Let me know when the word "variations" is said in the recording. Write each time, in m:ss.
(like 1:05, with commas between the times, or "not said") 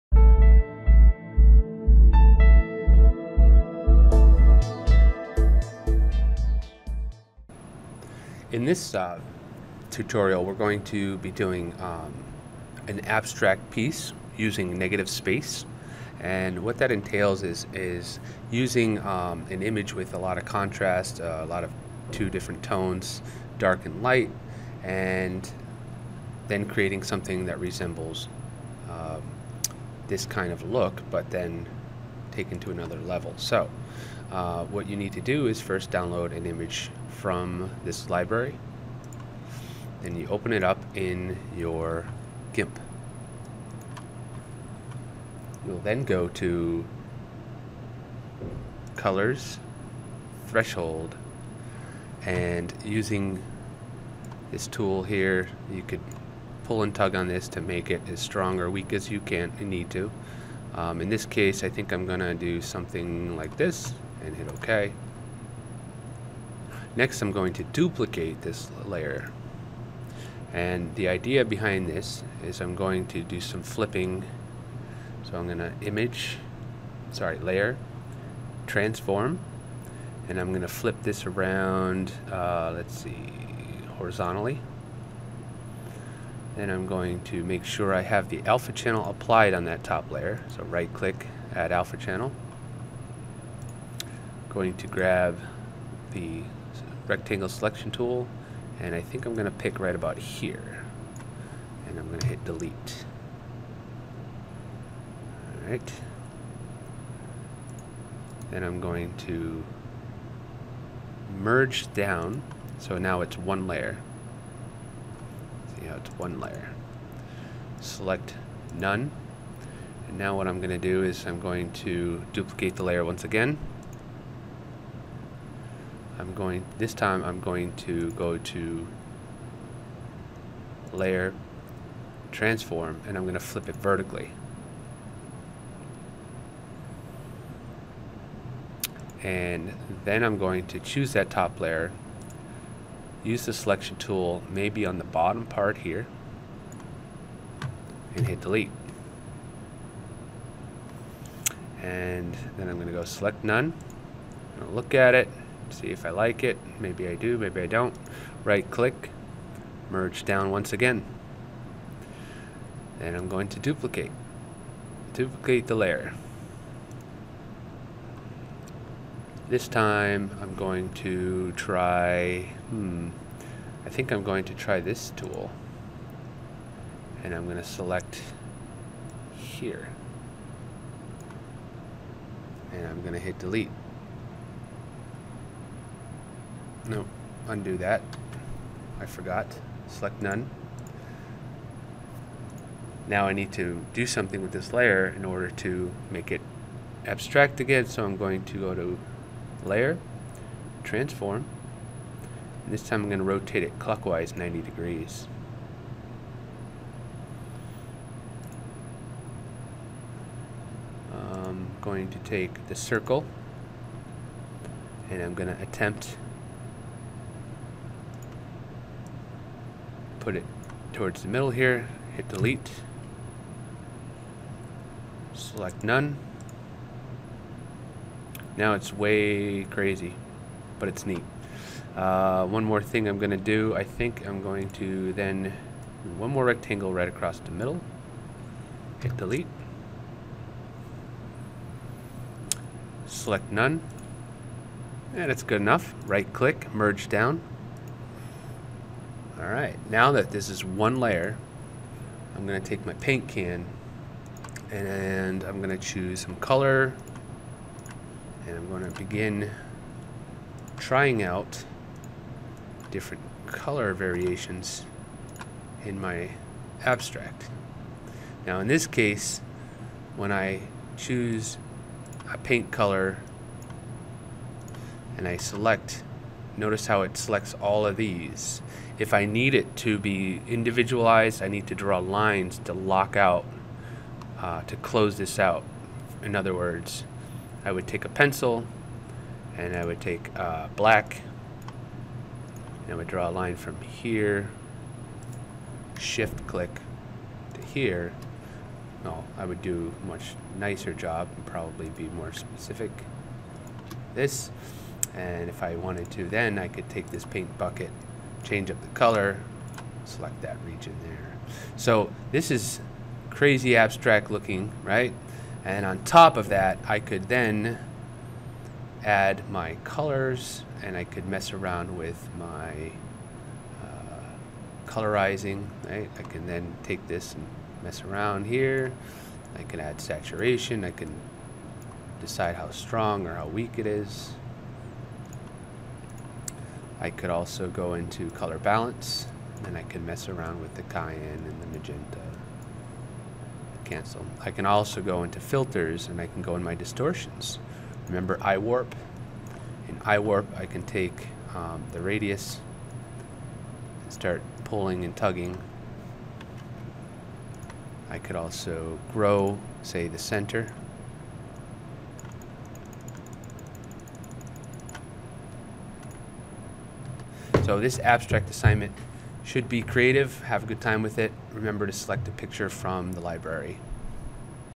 4:23.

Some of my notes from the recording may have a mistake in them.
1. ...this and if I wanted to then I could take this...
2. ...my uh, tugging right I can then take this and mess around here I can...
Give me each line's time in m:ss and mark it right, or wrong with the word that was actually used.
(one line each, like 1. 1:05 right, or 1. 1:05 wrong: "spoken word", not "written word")
1. 5:04 right
2. 5:22 wrong: "colorizing", not "tugging".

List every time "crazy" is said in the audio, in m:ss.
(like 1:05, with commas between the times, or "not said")
3:49, 5:13.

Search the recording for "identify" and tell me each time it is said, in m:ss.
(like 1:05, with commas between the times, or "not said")
not said.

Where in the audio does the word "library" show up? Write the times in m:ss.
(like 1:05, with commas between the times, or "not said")
0:38, 6:13.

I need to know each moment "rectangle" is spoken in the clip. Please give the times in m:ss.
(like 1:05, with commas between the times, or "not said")
1:37, 3:56.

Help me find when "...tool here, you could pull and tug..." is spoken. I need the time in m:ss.
0:54.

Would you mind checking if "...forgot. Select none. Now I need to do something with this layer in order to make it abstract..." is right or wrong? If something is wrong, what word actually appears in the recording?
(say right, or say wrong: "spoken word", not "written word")
right.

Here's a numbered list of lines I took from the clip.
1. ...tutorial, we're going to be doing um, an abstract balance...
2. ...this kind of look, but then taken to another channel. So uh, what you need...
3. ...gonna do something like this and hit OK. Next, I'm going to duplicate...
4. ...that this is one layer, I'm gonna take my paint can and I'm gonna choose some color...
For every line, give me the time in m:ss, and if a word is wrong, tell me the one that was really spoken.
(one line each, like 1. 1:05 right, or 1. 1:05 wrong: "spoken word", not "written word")
1. 0:09 wrong: "piece", not "balance"
2. 0:30 wrong: "level", not "channel"
3. 1:02 right
4. 4:10 right.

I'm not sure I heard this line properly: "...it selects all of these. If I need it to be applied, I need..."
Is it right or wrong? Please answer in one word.
wrong.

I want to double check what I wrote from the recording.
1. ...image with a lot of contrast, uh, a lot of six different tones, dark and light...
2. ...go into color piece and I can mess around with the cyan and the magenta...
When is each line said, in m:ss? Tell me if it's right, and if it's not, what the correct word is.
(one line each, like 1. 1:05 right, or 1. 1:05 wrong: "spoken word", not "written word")
1. 0:19 wrong: "two", not "six"
2. 5:37 wrong: "balance", not "piece".